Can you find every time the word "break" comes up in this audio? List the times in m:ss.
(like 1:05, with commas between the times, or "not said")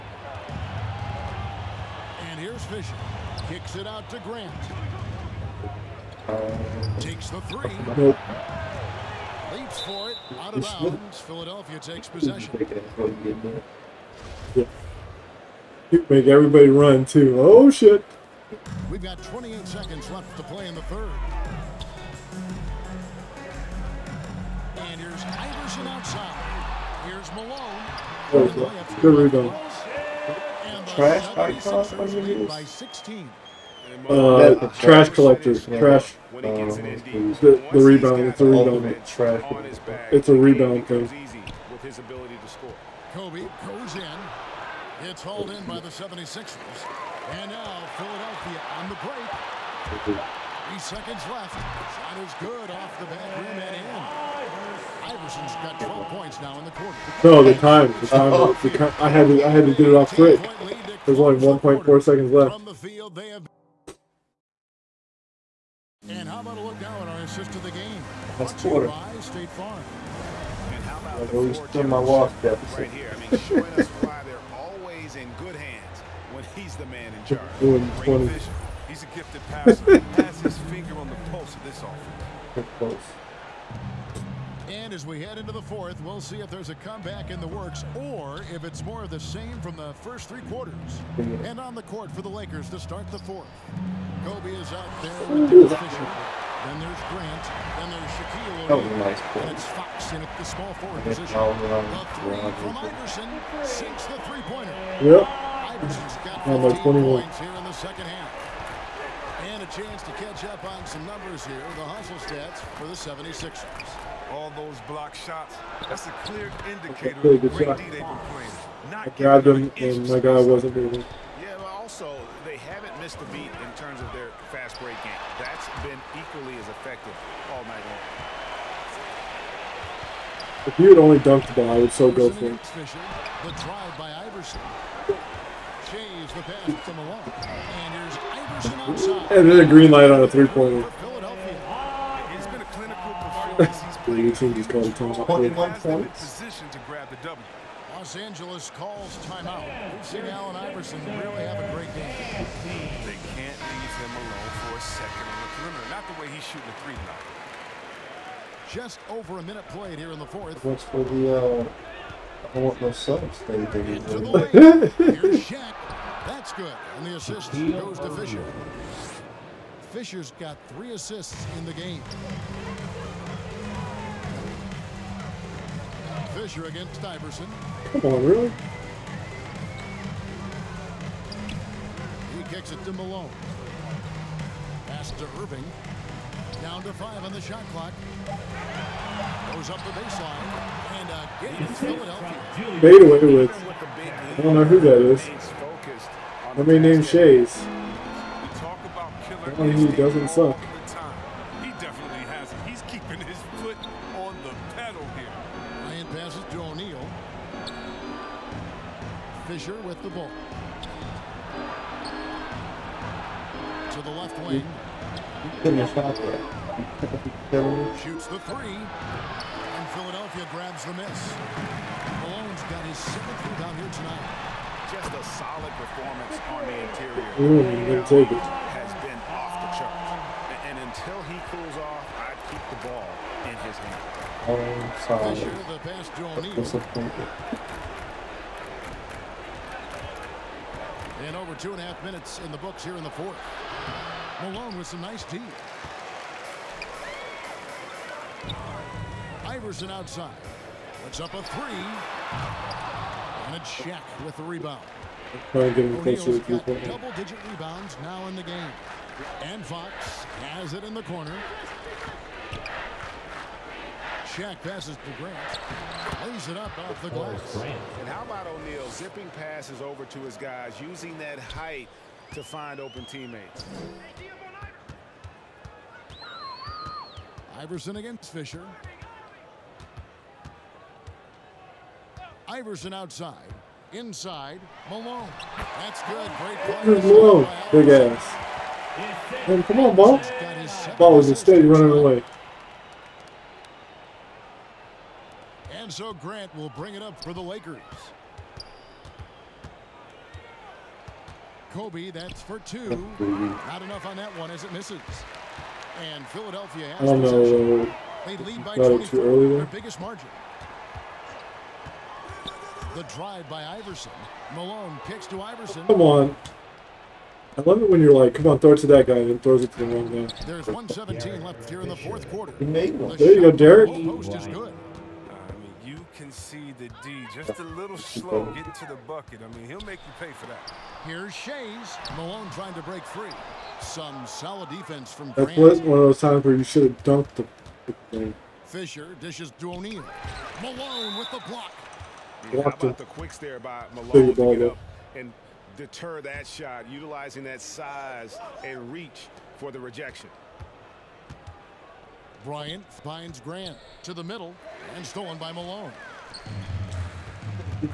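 0:49, 2:04, 5:32.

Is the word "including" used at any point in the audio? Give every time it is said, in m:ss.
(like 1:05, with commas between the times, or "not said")
not said.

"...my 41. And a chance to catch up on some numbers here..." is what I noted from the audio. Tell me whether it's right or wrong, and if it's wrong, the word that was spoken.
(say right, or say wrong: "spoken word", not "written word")
wrong: "21", not "41".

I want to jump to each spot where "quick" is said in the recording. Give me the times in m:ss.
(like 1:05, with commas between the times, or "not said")
1:00, 5:43.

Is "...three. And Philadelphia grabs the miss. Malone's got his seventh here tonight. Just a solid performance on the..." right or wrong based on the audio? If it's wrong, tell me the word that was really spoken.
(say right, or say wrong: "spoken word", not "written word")
right.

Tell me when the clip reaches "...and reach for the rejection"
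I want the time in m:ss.
5:48.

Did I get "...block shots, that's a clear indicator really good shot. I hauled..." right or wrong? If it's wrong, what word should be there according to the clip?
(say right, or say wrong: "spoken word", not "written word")
wrong: "grabbed", not "hauled".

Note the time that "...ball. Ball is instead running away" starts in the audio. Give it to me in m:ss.
4:49.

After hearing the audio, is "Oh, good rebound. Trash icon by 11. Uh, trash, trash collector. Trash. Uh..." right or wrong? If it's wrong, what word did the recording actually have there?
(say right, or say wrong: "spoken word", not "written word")
wrong: "16", not "11".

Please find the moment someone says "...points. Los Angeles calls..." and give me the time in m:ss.
2:25.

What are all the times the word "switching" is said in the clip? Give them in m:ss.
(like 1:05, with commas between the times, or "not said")
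not said.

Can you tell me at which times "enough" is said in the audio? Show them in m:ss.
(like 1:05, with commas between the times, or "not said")
5:03.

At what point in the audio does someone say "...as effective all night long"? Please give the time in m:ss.
2:06.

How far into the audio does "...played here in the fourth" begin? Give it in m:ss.
2:39.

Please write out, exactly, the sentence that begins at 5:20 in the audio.
There's 117 left here in the fourth quarter.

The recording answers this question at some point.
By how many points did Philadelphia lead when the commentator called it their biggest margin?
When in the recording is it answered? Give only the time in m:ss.
5:08.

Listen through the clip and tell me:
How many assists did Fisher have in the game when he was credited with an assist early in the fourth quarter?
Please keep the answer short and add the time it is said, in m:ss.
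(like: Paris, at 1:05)
3, at 2:50.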